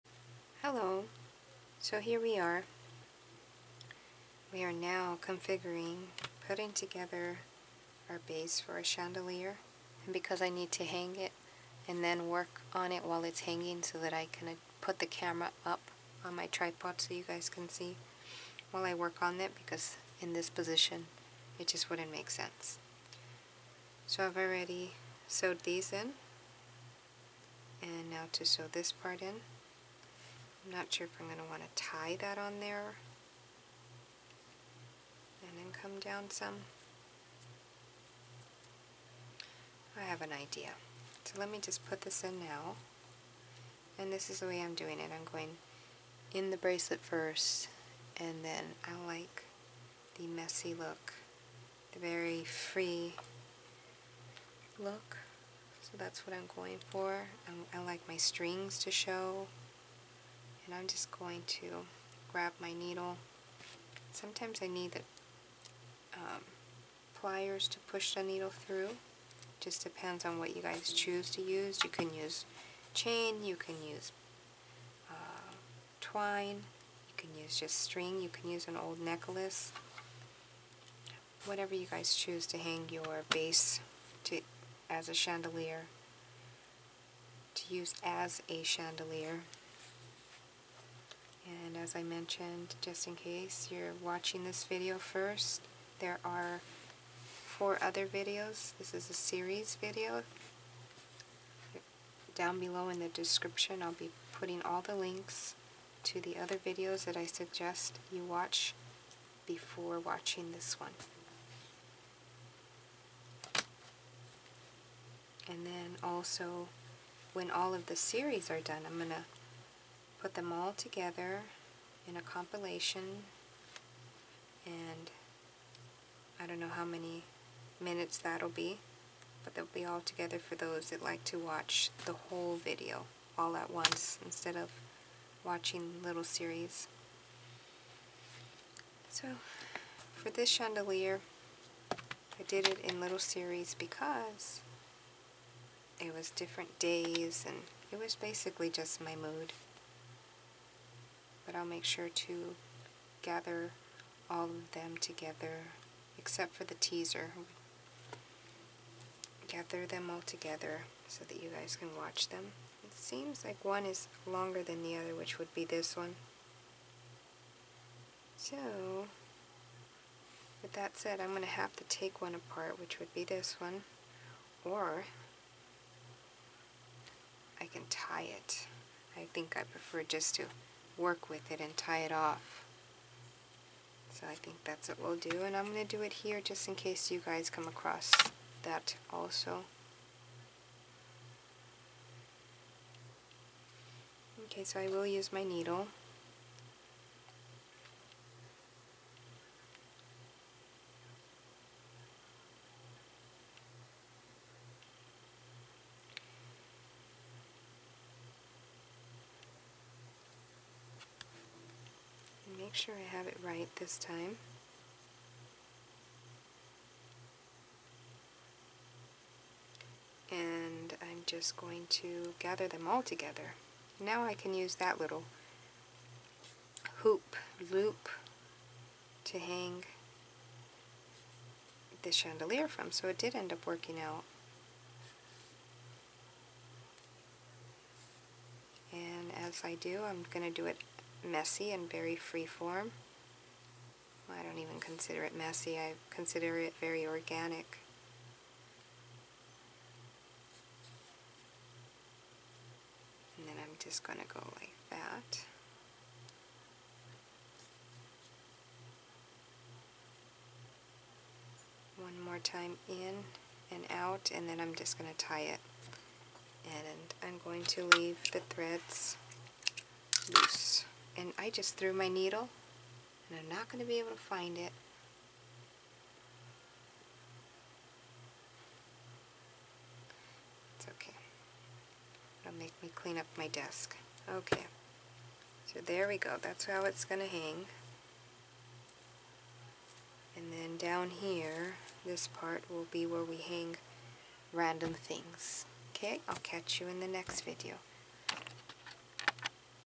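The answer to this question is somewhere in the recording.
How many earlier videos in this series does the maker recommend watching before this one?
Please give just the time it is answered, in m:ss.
1:37.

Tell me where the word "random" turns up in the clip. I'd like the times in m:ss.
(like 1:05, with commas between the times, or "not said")
4:54.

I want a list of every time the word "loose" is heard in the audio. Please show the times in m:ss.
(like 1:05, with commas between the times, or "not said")
4:30.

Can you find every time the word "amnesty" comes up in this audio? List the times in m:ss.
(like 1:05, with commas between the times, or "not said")
not said.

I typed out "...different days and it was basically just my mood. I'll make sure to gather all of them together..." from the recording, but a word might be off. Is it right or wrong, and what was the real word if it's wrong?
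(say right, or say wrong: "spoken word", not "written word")
right.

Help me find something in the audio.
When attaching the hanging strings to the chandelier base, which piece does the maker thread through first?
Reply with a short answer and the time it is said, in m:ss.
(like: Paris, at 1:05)
The bracelet, at 0:46.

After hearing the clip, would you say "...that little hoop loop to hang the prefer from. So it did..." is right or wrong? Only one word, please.
wrong.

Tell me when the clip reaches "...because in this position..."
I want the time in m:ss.
0:19.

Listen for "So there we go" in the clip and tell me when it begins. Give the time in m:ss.
4:45.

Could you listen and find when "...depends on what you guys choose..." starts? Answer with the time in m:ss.
1:09.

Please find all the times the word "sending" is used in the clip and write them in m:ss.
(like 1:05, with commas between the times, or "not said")
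not said.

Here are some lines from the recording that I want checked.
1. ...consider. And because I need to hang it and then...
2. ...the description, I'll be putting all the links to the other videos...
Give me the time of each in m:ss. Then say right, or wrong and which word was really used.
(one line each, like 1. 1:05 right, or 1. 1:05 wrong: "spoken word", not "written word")
1. 0:08 wrong: "chandelier", not "consider"
2. 1:42 right.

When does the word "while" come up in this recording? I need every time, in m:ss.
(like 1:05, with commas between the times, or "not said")
0:13, 0:18.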